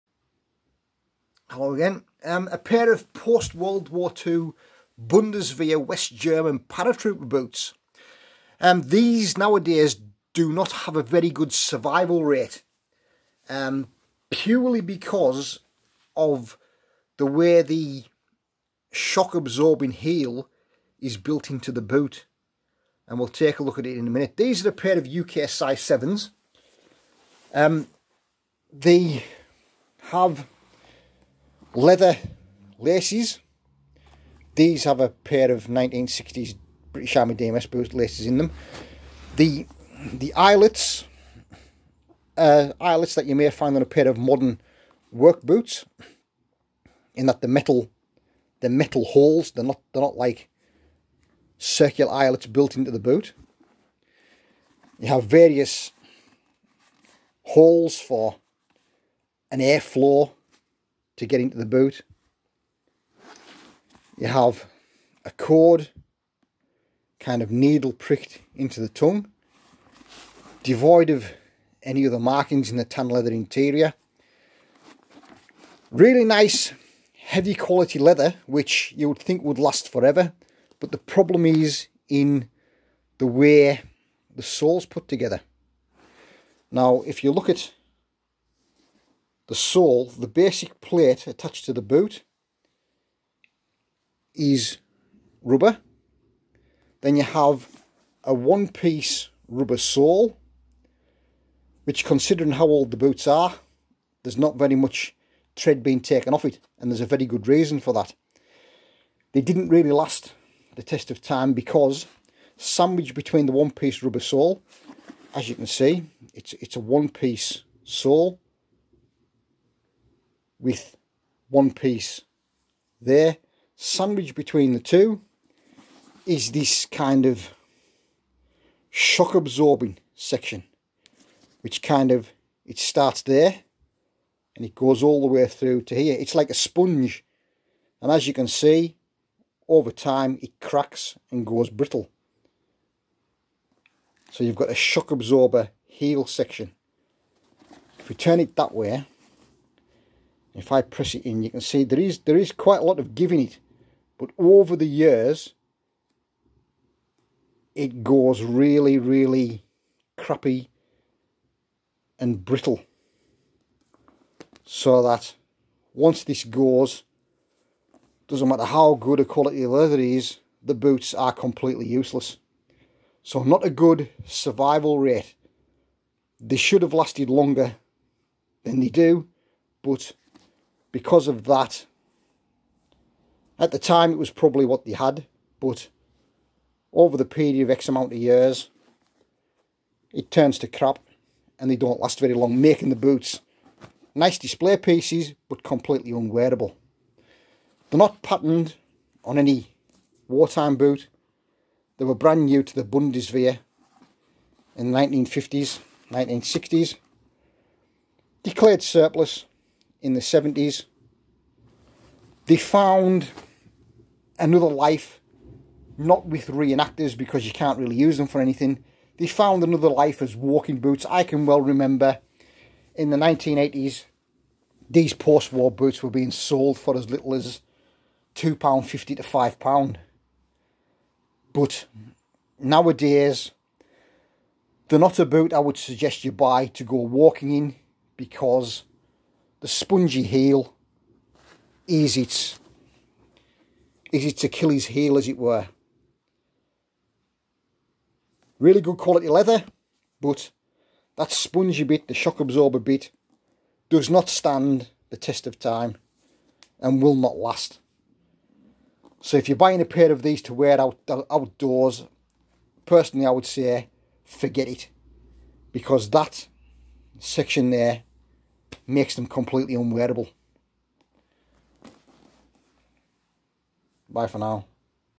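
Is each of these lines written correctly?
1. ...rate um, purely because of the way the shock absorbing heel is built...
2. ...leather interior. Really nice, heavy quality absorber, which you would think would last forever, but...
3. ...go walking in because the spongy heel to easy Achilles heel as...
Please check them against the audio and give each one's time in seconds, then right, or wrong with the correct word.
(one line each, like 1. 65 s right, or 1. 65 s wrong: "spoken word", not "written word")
1. 12 s right
2. 73 s wrong: "leather", not "absorber"
3. 236 s right.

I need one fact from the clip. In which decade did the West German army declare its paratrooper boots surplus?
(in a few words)
70s.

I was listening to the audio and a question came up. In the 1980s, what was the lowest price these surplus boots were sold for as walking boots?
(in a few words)
£2.50.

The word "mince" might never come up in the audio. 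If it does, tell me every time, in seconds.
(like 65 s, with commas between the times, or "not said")
not said.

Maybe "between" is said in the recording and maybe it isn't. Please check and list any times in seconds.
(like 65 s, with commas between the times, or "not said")
113 s, 124 s.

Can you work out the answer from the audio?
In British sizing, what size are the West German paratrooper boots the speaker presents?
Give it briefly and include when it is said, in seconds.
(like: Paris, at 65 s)
UK size 7, at 25 s.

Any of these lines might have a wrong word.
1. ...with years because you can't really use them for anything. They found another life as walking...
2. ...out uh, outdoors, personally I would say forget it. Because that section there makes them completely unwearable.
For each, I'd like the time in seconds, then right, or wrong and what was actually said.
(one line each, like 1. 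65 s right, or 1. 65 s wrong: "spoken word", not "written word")
1. 216 s wrong: "reenactors", not "years"
2. 260 s right.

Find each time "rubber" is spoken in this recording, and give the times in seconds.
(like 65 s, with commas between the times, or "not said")
95 s, 99 s, 114 s.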